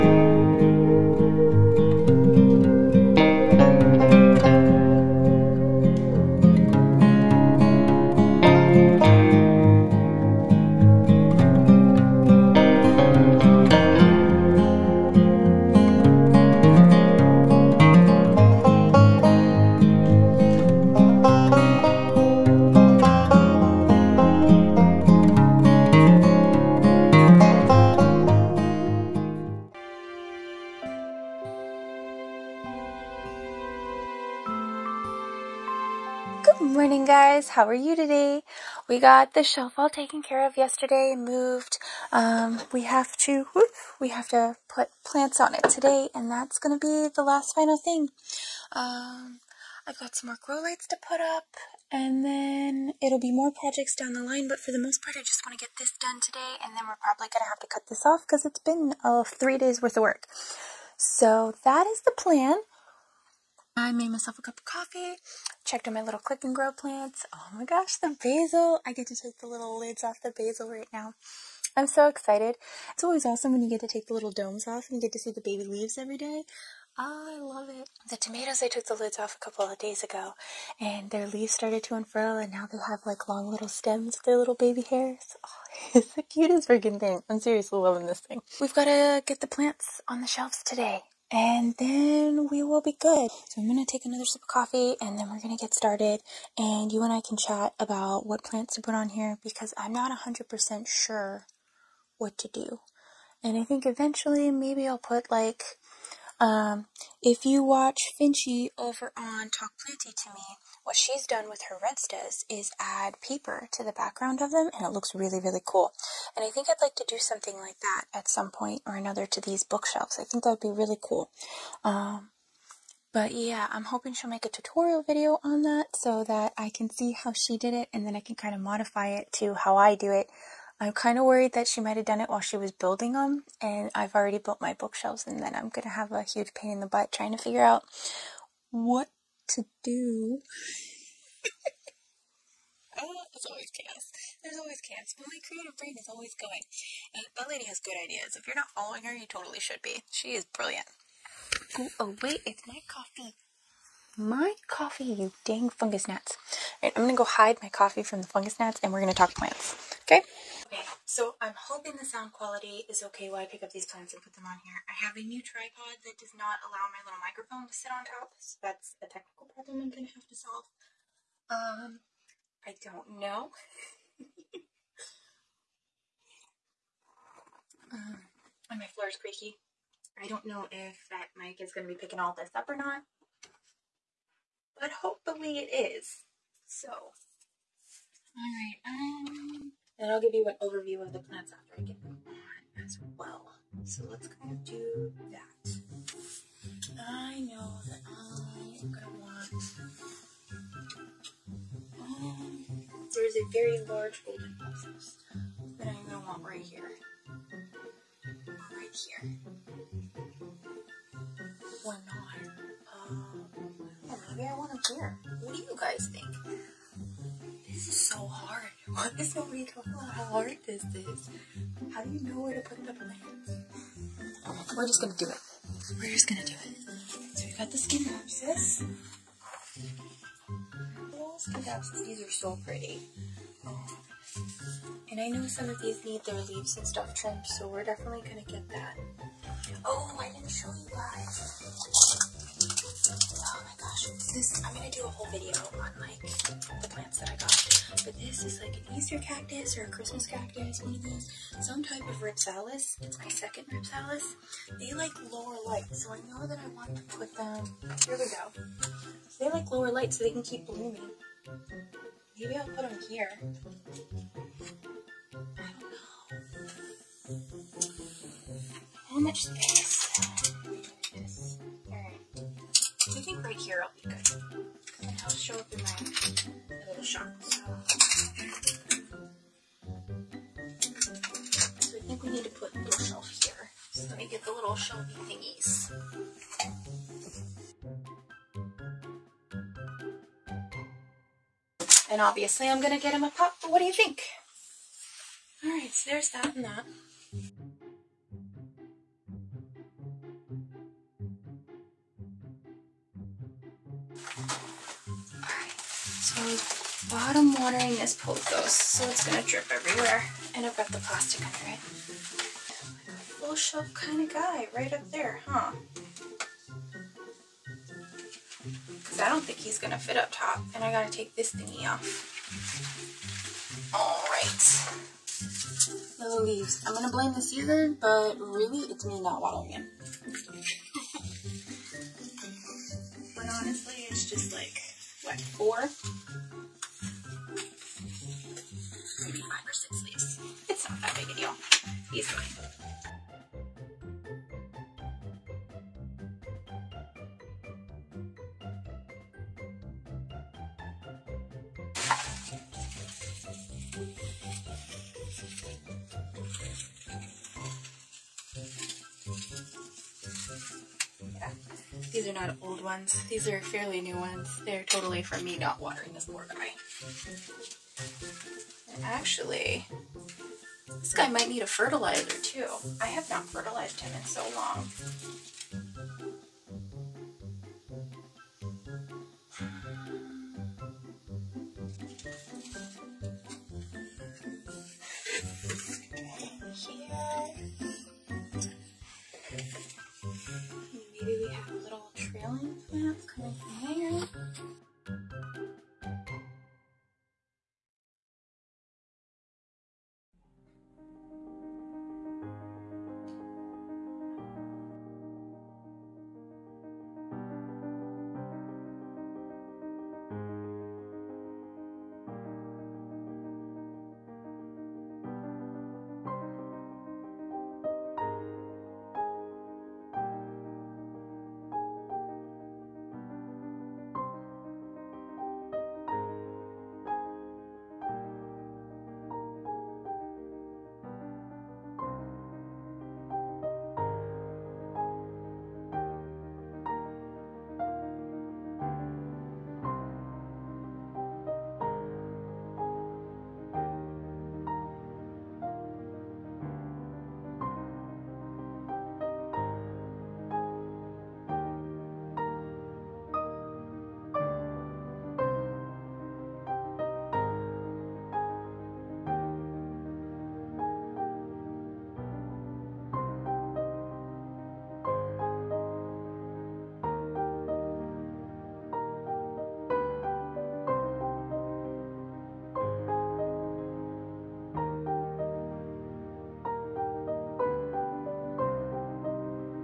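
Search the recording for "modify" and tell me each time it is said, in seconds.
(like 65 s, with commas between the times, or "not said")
128 s.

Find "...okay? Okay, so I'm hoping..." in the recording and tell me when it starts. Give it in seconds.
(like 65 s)
160 s.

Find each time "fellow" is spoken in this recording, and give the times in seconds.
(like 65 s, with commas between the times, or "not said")
not said.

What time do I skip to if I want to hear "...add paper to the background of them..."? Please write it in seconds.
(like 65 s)
112 s.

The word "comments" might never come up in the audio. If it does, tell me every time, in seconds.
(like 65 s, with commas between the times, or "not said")
not said.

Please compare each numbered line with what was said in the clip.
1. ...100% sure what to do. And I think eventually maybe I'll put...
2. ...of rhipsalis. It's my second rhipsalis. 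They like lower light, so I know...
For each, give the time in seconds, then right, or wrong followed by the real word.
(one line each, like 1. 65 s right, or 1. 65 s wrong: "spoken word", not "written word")
1. 100 s right
2. 252 s right.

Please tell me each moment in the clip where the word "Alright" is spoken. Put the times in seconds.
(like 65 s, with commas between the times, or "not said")
271 s, 305 s.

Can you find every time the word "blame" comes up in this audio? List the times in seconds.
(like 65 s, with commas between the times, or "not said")
327 s.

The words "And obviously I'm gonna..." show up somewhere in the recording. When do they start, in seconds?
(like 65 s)
292 s.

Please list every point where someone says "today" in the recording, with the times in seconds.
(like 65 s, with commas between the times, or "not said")
37 s, 45 s, 56 s, 90 s.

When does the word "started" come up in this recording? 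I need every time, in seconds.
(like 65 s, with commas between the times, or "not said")
81 s, 95 s.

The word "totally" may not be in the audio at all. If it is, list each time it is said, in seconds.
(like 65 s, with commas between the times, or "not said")
149 s, 364 s.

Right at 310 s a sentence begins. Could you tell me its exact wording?
And I've got the plastic under it.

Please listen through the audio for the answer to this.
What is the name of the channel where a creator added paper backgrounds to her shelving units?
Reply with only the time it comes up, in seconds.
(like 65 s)
109 s.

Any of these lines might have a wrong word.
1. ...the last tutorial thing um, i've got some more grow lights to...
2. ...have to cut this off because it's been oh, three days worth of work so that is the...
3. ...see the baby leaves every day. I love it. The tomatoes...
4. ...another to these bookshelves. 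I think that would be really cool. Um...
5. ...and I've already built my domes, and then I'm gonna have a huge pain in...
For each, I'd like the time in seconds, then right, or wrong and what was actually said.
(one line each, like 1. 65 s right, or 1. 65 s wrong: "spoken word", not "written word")
1. 47 s wrong: "final", not "tutorial"
2. 57 s right
3. 75 s right
4. 118 s right
5. 133 s wrong: "bookshelves", not "domes".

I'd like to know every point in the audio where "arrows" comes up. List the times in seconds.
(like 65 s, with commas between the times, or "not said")
not said.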